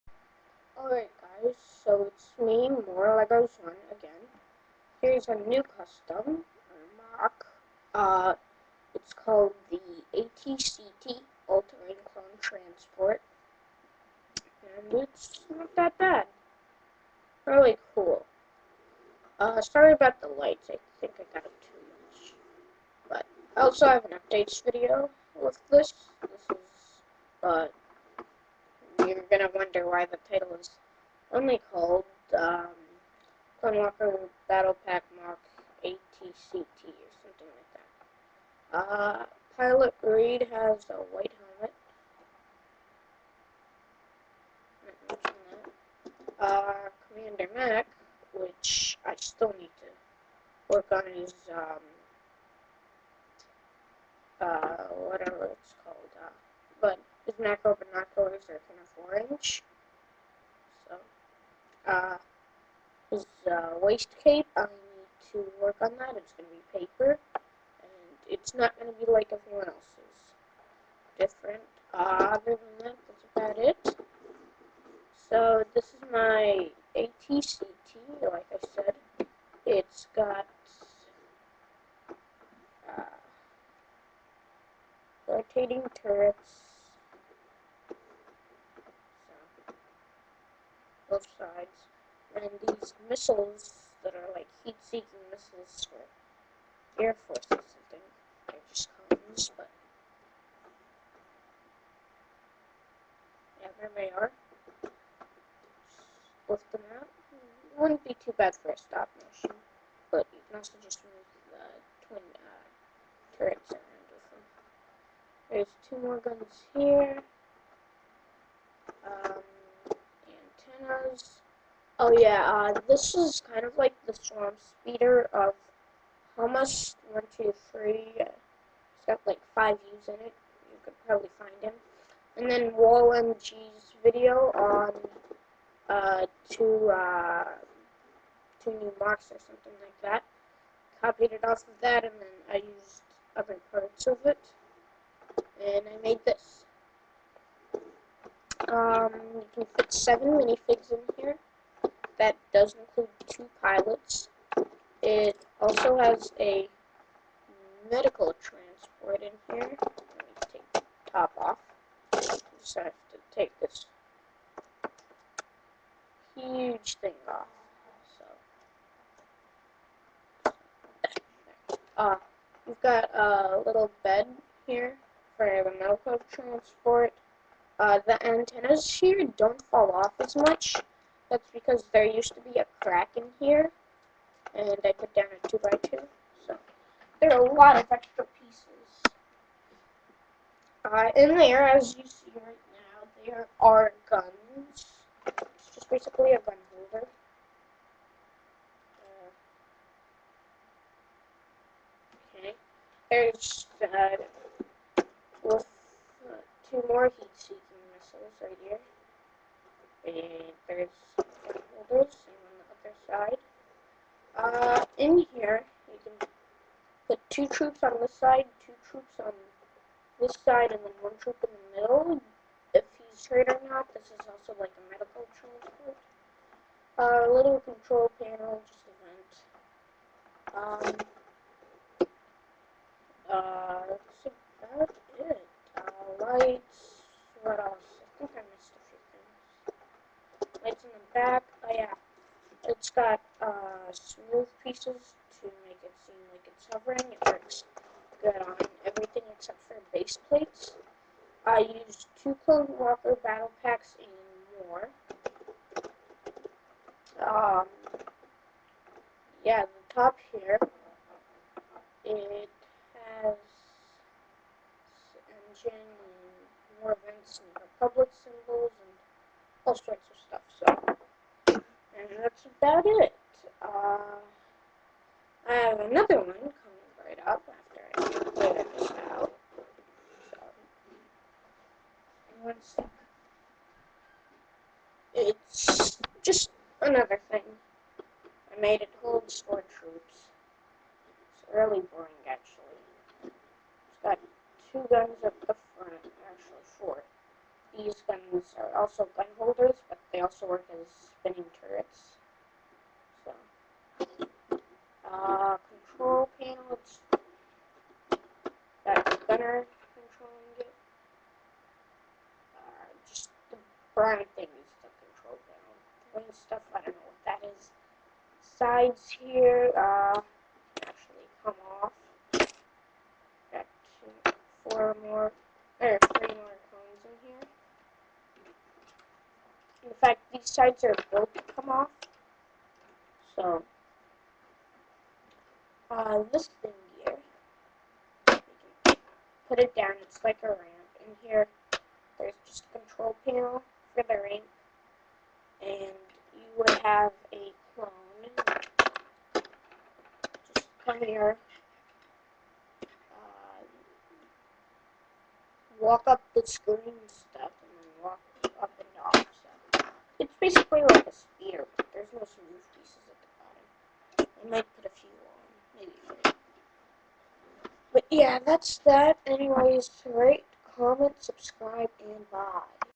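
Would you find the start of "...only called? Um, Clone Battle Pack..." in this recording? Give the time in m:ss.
0:31.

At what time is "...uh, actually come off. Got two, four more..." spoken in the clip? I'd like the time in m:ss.
5:19.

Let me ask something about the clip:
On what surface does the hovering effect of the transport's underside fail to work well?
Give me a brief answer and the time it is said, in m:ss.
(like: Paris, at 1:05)
Base plates, at 4:09.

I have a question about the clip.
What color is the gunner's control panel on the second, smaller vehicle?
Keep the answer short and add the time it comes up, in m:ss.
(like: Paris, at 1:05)
Brown, at 5:13.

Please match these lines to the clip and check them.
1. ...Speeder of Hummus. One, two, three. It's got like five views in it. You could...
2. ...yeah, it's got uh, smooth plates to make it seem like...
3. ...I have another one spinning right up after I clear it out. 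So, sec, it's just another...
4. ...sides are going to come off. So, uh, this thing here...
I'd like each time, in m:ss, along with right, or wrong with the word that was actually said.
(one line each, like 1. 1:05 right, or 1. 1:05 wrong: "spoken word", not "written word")
1. 2:04 right
2. 4:01 wrong: "pieces", not "plates"
3. 4:35 wrong: "coming", not "spinning"
4. 5:30 right.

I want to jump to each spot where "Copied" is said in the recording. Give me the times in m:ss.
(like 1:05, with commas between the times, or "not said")
2:21.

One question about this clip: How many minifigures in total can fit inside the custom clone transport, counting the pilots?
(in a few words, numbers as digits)
7.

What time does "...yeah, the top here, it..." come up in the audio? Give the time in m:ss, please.
4:19.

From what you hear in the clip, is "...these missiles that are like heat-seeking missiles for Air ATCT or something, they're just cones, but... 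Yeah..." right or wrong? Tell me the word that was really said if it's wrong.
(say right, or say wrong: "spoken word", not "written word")
wrong: "Force", not "ATCT".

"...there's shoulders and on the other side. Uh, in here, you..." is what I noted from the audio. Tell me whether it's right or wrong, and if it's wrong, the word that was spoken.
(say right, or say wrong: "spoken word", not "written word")
right.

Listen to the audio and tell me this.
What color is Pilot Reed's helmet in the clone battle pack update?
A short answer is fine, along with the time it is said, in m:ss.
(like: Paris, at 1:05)
White, at 0:41.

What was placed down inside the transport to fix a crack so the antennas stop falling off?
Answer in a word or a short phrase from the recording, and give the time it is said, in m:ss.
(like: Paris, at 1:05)
A 2x2, at 3:05.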